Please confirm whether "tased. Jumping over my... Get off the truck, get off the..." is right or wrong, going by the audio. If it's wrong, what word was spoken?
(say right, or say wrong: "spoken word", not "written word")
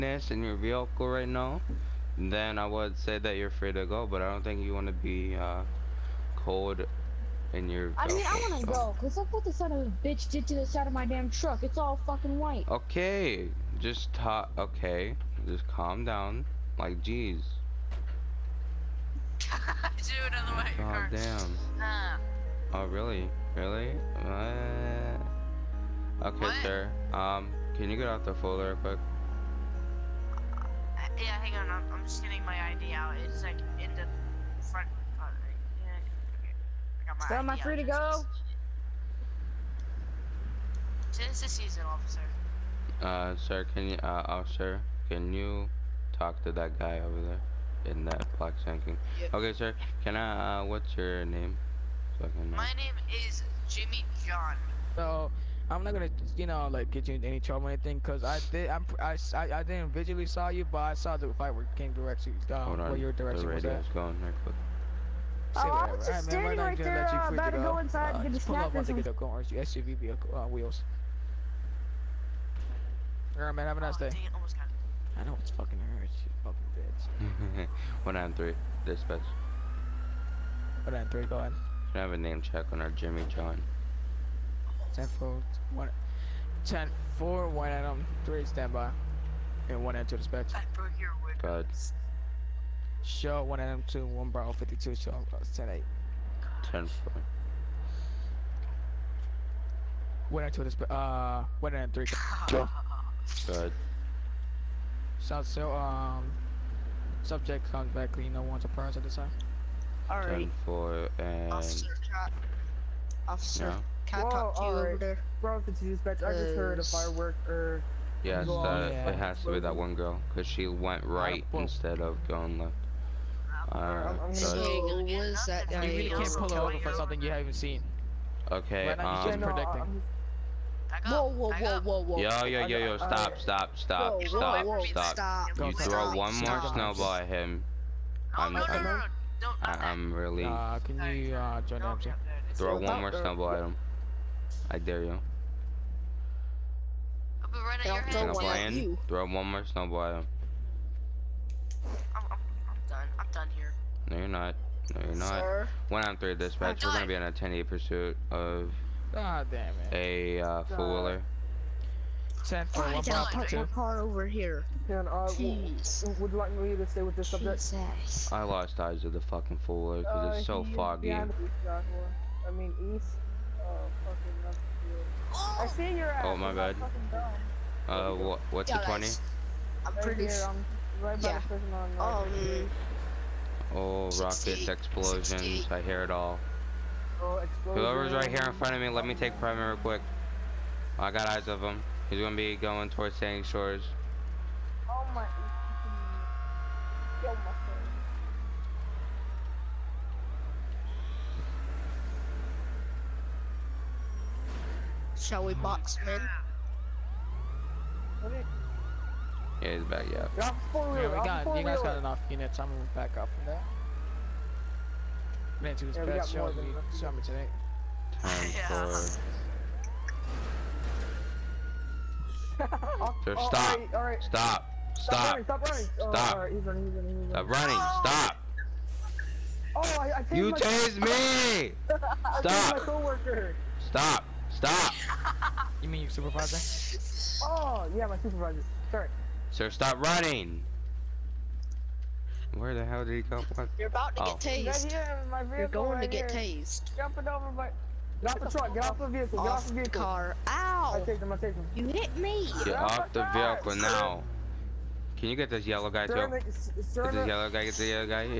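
right.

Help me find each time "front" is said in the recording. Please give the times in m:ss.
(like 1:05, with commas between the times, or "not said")
0:34, 3:08.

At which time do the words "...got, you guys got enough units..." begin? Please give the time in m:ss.
3:31.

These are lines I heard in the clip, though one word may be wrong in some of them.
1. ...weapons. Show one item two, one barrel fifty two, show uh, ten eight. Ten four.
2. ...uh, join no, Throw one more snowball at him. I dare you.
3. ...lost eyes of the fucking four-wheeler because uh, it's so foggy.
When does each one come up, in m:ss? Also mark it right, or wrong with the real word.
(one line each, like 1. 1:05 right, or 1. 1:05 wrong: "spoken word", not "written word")
1. 1:31 right
2. 2:21 right
3. 2:48 right.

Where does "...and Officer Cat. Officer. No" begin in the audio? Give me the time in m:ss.
1:51.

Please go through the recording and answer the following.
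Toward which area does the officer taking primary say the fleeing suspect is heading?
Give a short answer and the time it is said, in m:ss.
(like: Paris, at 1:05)
Sandy Shores, at 3:13.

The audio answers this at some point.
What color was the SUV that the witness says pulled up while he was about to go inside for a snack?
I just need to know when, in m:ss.
1:09.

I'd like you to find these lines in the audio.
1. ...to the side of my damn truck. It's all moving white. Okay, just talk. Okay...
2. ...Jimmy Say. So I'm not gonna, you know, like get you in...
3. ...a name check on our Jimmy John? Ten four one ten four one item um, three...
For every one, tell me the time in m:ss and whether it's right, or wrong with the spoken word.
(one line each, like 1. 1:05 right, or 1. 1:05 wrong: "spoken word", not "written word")
1. 0:10 wrong: "fucking", not "moving"
2. 0:53 wrong: "John", not "Say"
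3. 1:22 right.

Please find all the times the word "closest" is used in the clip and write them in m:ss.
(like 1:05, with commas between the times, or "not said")
not said.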